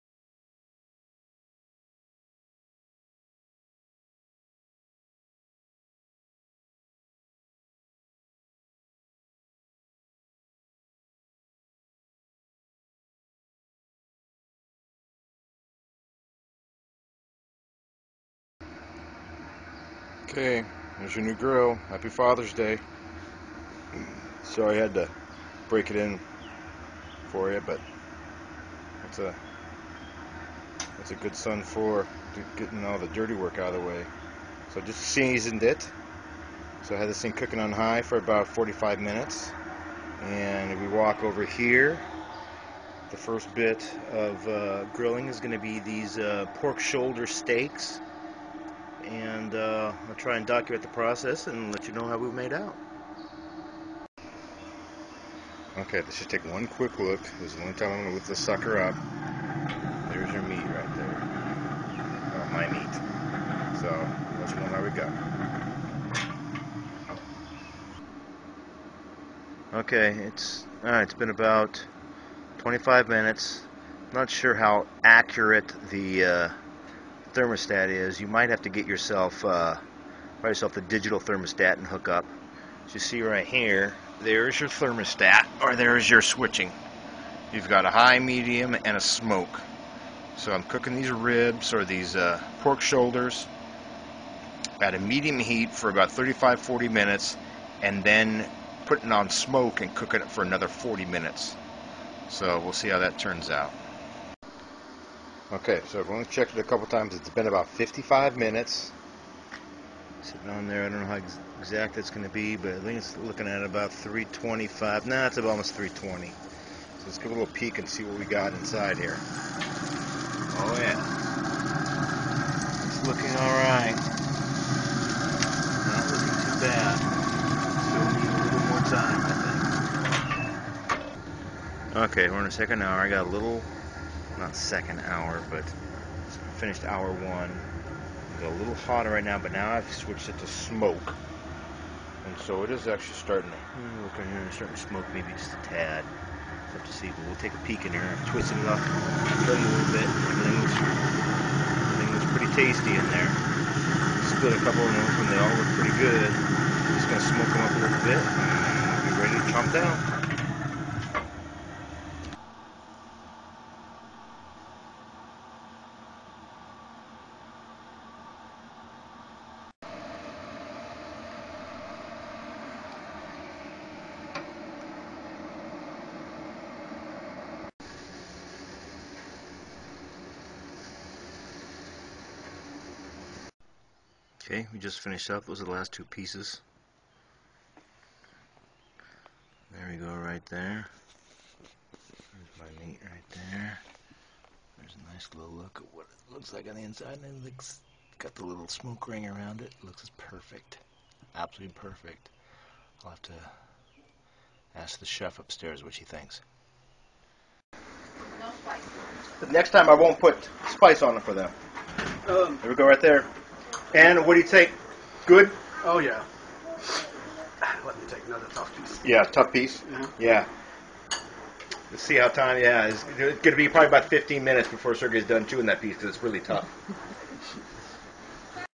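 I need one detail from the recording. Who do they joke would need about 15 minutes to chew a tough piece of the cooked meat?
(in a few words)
Sergey.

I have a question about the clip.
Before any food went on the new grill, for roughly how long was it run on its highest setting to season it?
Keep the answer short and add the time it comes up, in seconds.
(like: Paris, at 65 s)
45 minutes, at 38 s.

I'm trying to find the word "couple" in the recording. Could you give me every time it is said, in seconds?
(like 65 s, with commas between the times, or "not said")
106 s, 154 s.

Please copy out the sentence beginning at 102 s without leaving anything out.
So we'll see how that turns out.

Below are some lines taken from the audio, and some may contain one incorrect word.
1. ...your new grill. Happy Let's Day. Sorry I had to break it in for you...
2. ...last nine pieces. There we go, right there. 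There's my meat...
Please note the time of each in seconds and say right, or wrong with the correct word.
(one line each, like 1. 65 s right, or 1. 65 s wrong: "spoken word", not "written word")
1. 21 s wrong: "Father", not "Let"
2. 185 s wrong: "two", not "nine".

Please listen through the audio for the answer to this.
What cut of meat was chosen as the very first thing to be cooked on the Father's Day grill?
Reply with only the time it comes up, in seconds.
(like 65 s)
46 s.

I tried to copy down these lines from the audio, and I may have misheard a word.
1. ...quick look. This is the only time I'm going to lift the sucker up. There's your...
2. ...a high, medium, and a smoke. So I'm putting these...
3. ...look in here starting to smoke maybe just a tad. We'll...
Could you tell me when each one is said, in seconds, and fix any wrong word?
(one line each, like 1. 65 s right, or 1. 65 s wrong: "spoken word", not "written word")
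1. 56 s right
2. 87 s wrong: "cooking", not "putting"
3. 144 s right.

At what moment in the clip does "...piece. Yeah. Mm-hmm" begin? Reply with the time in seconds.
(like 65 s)
219 s.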